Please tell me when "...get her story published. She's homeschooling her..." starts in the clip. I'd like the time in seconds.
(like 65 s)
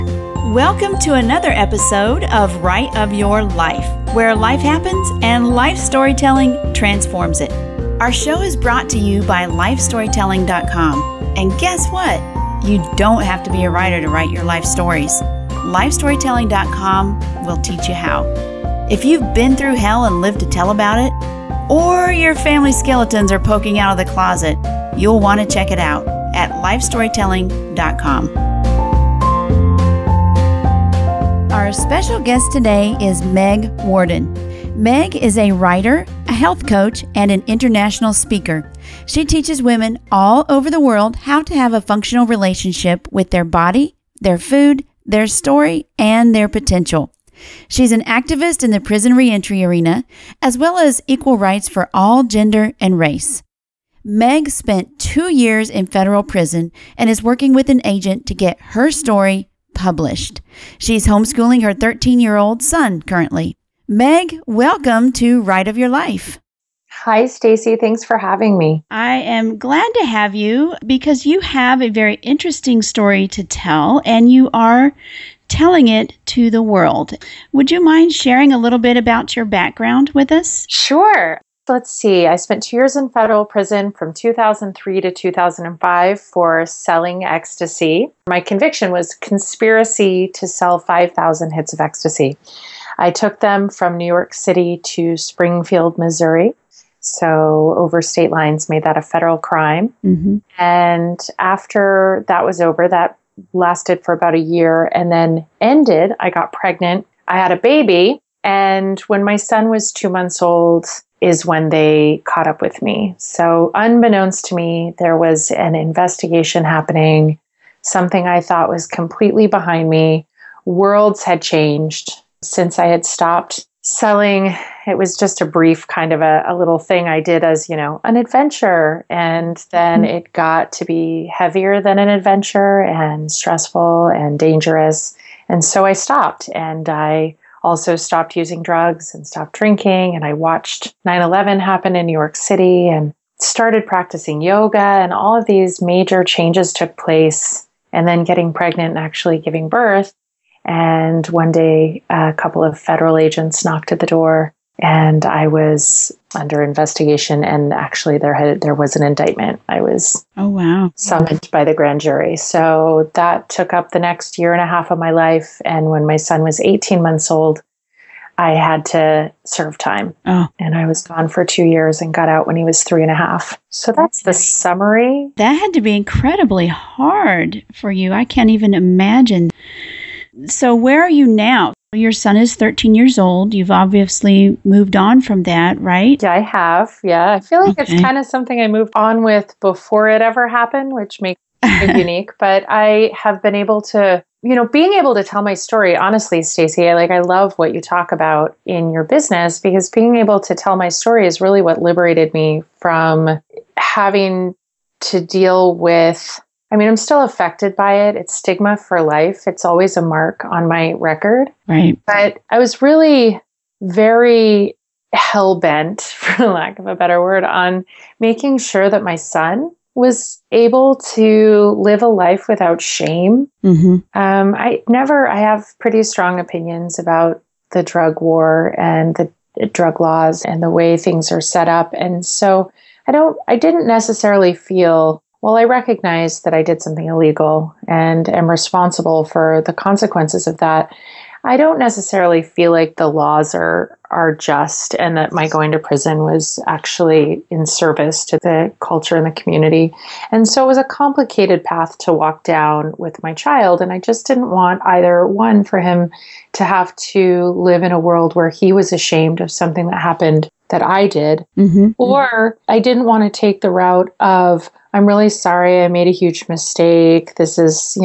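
58 s.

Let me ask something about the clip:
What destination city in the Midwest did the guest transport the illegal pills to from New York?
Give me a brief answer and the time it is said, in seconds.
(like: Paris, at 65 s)
Springfield, Missouri, at 95 s.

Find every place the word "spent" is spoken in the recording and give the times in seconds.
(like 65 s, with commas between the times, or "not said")
54 s, 82 s.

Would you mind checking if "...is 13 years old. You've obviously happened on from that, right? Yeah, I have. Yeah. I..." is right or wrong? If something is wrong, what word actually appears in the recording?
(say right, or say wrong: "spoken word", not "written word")
wrong: "moved", not "happened".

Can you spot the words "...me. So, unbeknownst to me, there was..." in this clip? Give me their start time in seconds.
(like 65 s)
112 s.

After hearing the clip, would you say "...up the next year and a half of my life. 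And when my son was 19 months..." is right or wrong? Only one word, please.
wrong.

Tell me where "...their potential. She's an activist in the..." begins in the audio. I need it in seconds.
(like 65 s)
46 s.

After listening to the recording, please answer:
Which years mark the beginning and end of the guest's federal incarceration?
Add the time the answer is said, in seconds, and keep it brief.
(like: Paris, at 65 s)
2003 to 2005, at 84 s.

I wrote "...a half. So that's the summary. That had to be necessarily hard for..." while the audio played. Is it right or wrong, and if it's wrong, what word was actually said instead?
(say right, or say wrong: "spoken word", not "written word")
wrong: "incredibly", not "necessarily".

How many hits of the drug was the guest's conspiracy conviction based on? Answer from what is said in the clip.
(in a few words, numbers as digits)
5000.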